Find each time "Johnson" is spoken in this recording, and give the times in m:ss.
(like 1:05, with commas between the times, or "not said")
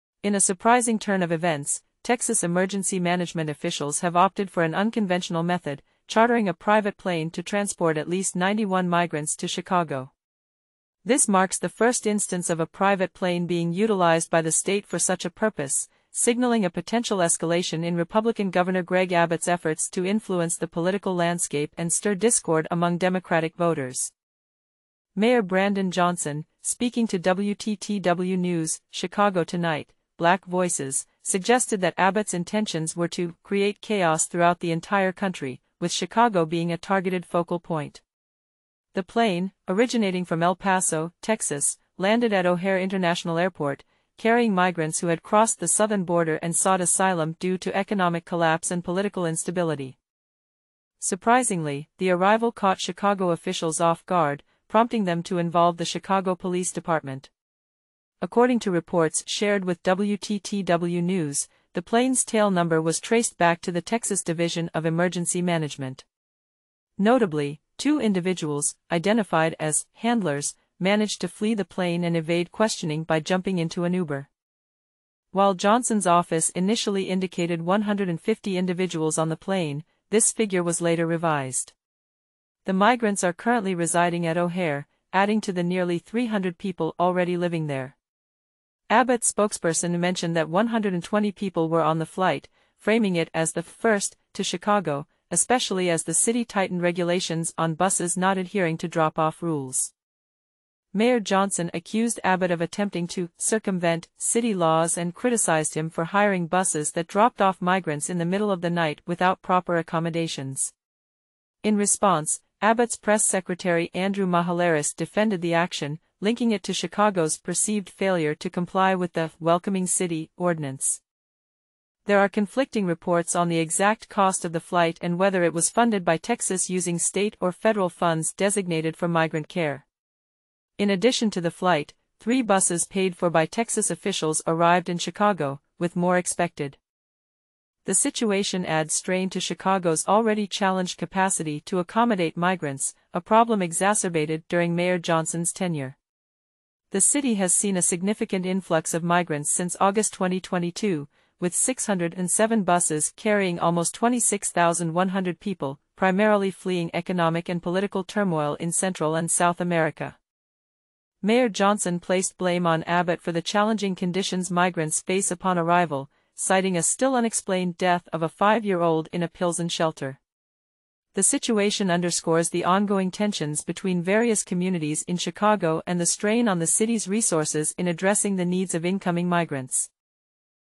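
0:25, 1:15, 1:41, 2:24, 2:41.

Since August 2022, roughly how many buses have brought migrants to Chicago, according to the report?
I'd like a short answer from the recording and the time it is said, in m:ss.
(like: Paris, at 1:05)
607, at 2:31.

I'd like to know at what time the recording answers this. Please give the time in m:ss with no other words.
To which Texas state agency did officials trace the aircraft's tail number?
1:03.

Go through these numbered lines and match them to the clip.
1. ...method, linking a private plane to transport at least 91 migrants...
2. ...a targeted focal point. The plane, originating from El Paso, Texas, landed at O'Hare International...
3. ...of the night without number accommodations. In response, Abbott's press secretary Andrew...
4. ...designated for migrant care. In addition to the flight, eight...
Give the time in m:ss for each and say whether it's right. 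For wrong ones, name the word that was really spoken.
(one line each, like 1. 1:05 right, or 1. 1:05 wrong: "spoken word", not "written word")
1. 0:05 wrong: "chartering", not "linking"
2. 0:36 right
3. 1:48 wrong: "proper", not "number"
4. 2:08 wrong: "three", not "eight".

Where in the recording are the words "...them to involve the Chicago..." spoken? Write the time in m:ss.
0:55.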